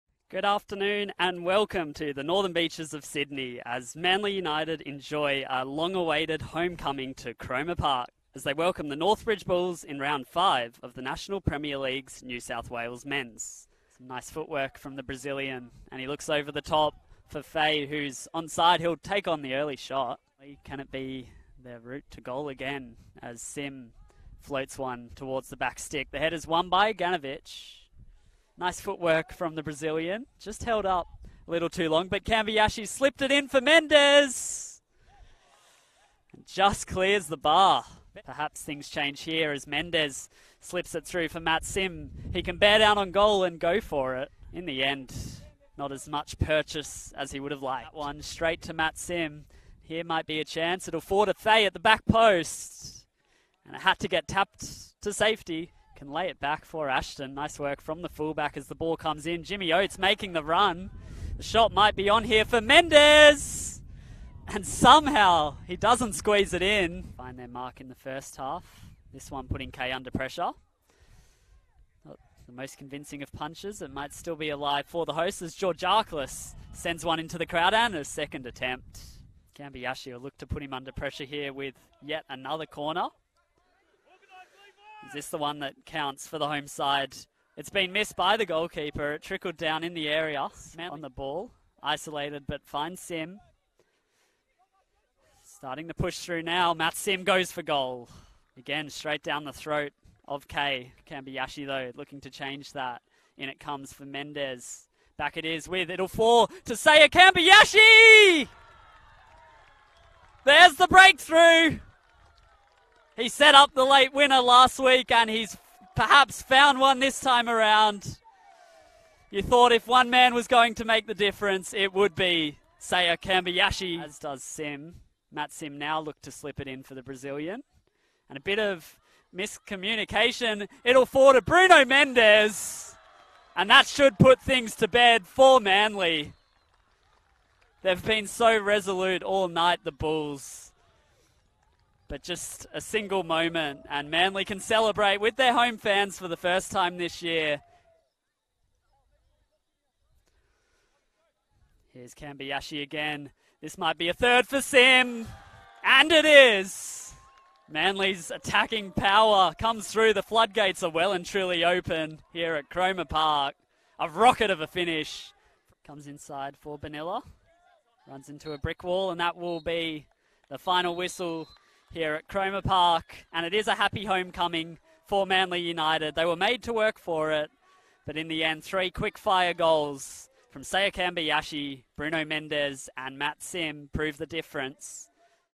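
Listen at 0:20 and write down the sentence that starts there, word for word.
Can it be their route to goal again as Sim floats one towards the back stick?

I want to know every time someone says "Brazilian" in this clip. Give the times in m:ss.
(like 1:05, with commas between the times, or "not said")
0:15, 0:29, 2:07.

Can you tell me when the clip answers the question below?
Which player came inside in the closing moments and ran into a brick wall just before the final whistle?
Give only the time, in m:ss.
2:46.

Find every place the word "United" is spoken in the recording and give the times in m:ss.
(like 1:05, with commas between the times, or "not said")
0:04, 2:55.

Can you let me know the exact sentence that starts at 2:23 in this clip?
And Manly can celebrate with their home fans for the first time this year.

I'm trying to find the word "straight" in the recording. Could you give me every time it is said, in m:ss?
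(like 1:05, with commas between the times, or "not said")
0:48, 1:38.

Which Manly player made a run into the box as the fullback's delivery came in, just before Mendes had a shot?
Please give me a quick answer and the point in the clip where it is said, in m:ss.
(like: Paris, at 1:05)
Jimmy Oates, at 0:59.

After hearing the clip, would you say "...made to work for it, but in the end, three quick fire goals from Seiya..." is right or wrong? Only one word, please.
right.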